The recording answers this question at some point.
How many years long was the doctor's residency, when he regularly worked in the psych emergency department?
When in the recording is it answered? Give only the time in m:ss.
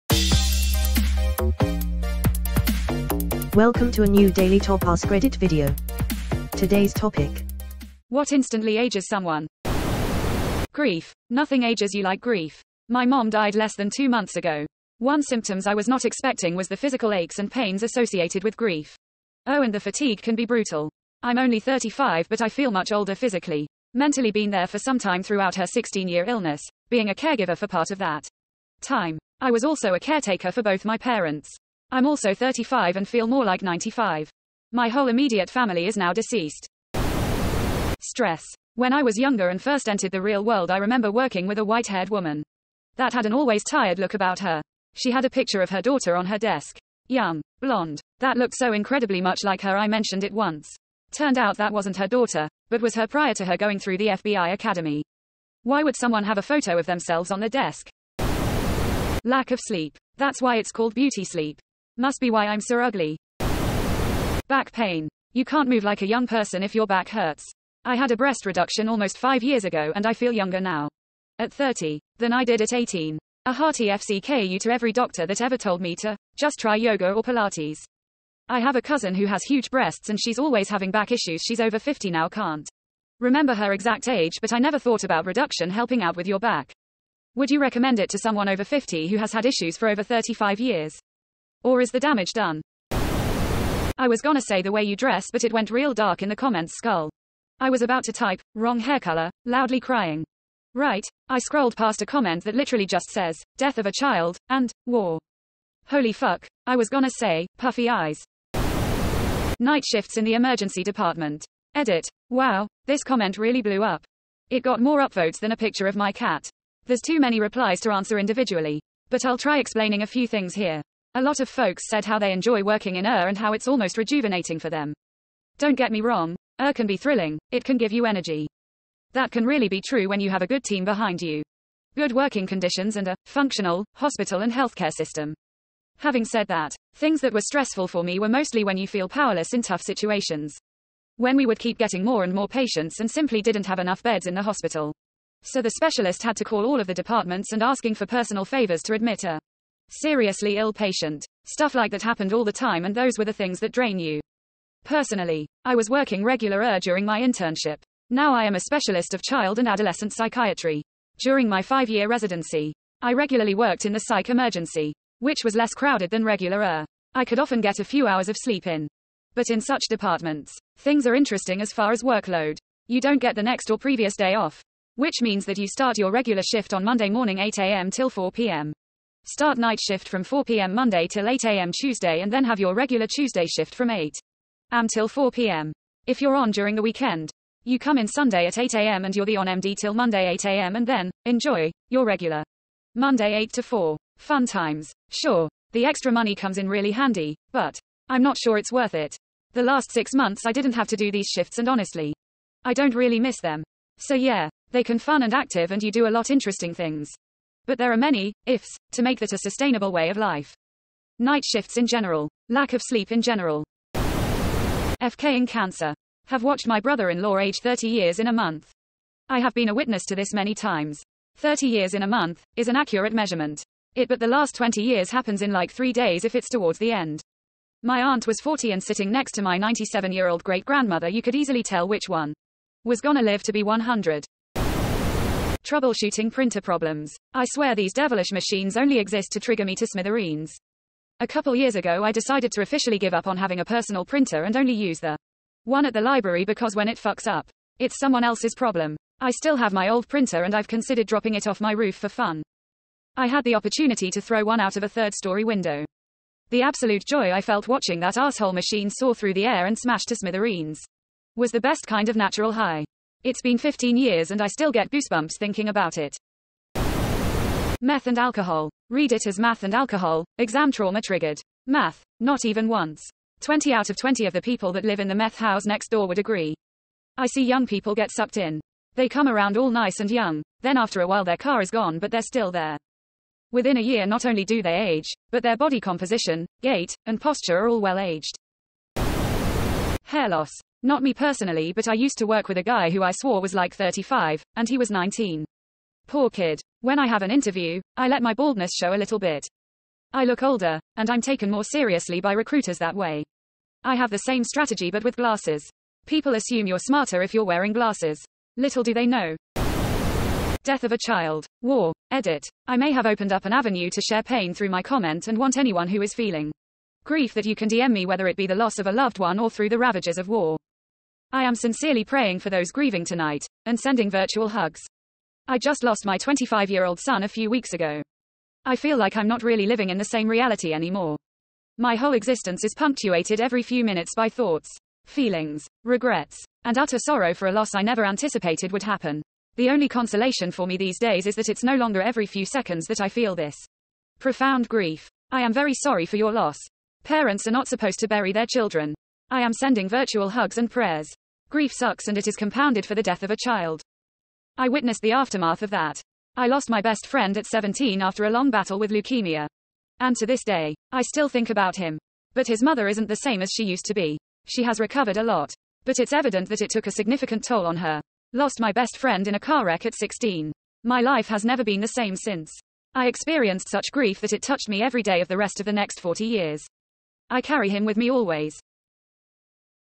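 2:41.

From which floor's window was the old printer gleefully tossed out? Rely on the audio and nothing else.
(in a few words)
Third story.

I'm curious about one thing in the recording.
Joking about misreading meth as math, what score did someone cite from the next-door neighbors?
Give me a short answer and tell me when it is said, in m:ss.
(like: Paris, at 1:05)
20 out of 20, at 4:33.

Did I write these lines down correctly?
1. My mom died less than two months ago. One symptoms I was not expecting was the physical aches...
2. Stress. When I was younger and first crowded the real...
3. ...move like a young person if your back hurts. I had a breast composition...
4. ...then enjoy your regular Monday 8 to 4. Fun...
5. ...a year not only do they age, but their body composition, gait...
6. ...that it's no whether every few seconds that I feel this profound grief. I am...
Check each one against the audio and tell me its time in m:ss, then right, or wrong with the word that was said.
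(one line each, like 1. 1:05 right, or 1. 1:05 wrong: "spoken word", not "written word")
1. 0:12 right
2. 0:38 wrong: "entered", not "crowded"
3. 1:05 wrong: "reduction", not "composition"
4. 3:10 right
5. 4:43 right
6. 5:41 wrong: "longer", not "whether".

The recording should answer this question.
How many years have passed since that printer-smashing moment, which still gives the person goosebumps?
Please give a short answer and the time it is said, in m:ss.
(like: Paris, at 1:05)
15, at 4:23.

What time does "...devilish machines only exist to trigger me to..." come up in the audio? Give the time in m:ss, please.
3:57.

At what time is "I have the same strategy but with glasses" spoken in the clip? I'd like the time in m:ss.
5:03.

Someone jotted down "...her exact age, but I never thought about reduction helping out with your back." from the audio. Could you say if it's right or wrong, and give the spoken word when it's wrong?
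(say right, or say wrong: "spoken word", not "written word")
right.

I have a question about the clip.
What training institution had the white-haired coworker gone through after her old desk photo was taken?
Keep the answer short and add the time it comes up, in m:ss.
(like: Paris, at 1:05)
FBI academy, at 0:54.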